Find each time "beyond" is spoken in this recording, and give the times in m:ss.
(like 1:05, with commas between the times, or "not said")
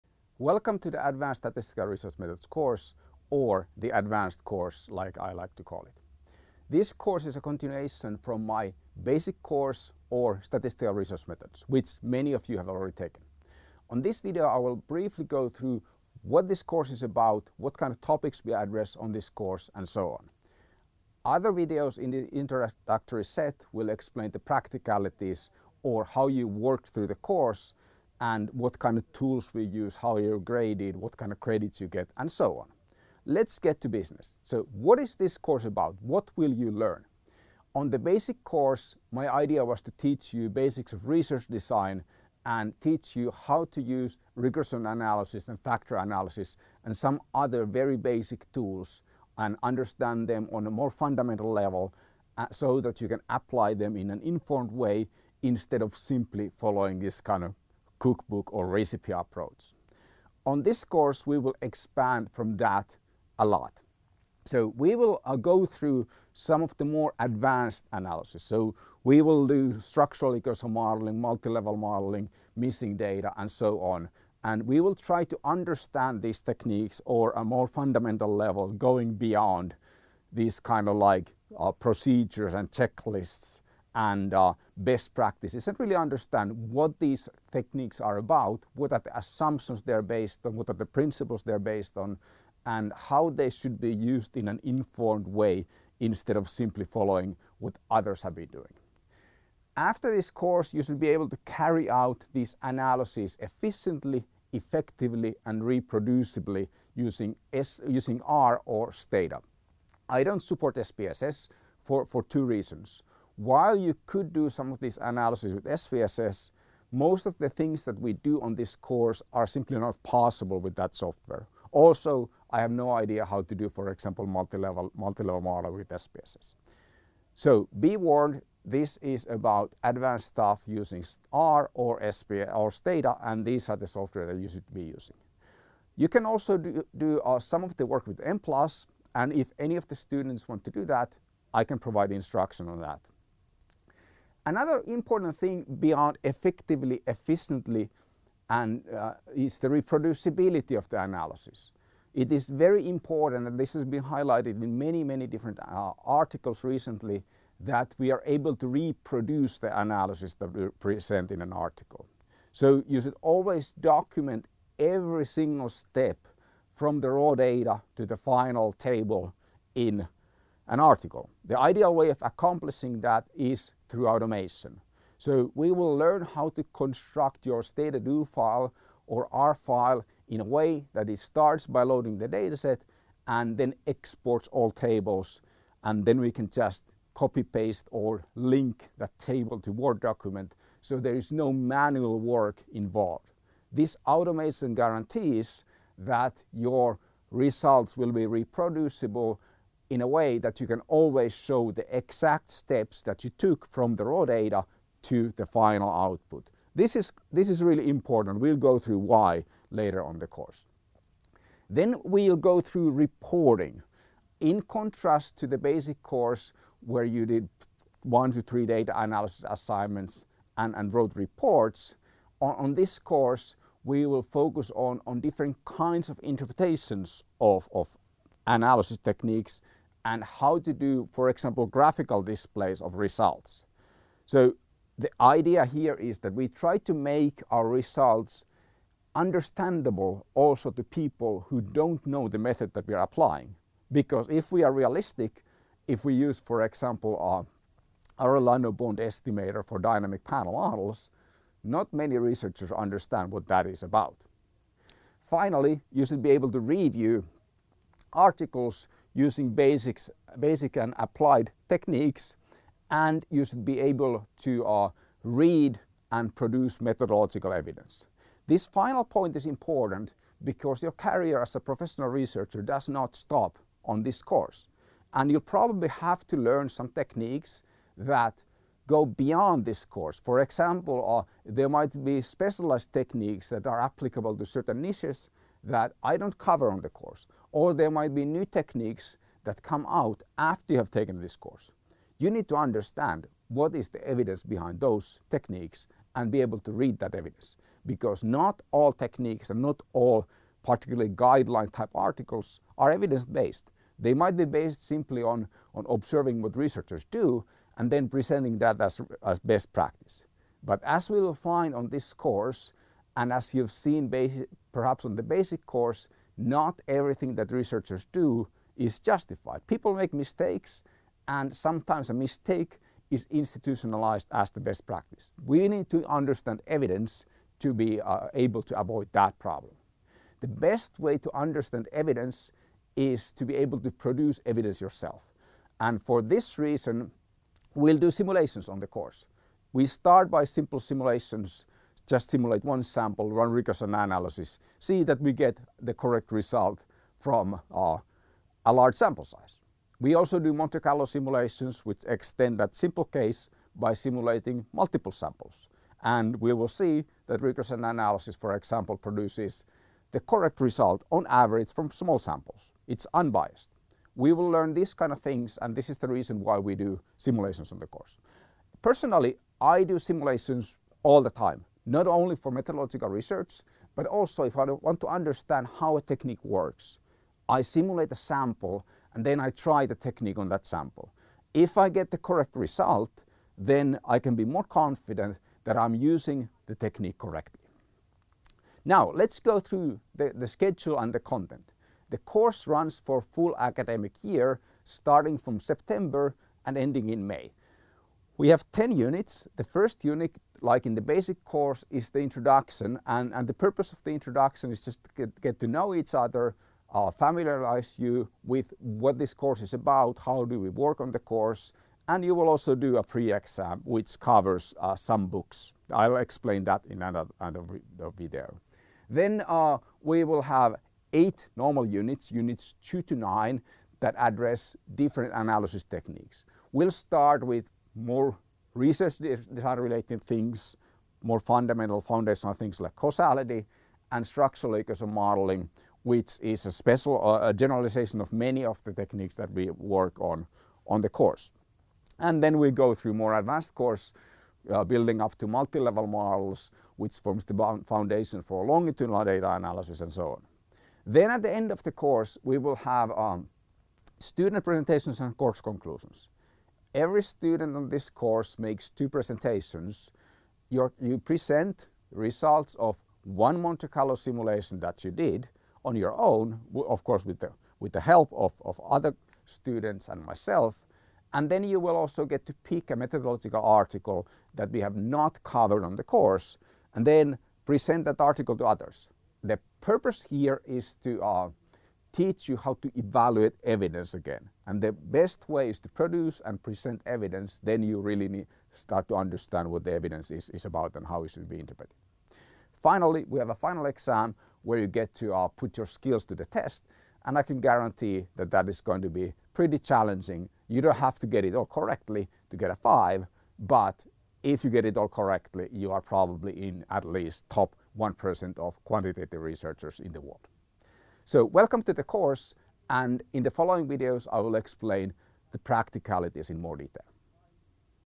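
1:19, 2:25, 4:39.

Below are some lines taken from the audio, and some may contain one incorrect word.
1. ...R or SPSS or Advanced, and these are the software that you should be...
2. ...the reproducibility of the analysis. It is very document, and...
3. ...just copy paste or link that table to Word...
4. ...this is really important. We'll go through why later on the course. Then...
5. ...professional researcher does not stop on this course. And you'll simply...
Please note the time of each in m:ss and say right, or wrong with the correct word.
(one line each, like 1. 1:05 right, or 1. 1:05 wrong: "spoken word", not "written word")
1. 2:11 wrong: "Stata", not "Advanced"
2. 2:29 wrong: "important", not "document"
3. 3:06 right
4. 3:27 right
5. 4:31 wrong: "probably", not "simply".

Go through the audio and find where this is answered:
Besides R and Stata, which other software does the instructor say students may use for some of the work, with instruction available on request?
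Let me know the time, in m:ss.
2:18.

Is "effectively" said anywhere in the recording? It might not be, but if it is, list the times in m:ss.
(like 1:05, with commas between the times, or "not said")
1:44, 2:26.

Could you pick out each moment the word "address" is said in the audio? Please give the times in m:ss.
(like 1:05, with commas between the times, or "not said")
0:18, 7:04.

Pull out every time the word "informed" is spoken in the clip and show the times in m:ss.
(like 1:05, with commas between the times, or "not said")
0:54, 1:34.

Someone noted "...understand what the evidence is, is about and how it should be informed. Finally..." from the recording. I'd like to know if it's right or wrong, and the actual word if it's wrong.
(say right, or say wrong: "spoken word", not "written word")
wrong: "interpreted", not "informed".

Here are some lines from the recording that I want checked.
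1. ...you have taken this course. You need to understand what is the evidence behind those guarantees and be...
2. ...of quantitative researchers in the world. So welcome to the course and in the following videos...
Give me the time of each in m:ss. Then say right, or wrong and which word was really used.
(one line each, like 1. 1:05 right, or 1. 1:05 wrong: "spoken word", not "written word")
1. 4:50 wrong: "techniques", not "guarantees"
2. 8:28 right.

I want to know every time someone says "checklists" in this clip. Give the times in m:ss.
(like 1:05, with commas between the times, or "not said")
1:22.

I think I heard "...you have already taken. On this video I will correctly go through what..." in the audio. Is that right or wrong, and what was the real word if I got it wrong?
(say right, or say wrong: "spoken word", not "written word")
wrong: "briefly", not "correctly".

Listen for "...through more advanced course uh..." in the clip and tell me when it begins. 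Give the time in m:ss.
7:22.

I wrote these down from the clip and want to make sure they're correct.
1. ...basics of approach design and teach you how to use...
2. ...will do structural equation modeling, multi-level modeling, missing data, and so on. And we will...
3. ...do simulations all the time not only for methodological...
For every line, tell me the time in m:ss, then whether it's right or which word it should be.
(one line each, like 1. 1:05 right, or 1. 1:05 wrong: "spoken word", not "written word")
1. 0:40 wrong: "research", not "approach"
2. 1:09 right
3. 6:09 right.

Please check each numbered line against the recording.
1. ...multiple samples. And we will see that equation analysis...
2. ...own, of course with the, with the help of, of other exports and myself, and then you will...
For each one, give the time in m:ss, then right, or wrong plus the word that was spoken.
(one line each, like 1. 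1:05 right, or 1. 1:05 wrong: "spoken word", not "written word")
1. 5:54 wrong: "regression", not "equation"
2. 7:46 wrong: "students", not "exports".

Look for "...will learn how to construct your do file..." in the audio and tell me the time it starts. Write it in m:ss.
2:55.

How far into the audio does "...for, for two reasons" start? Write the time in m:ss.
1:51.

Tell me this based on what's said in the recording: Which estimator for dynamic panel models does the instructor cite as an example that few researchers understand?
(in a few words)
Bond estimator.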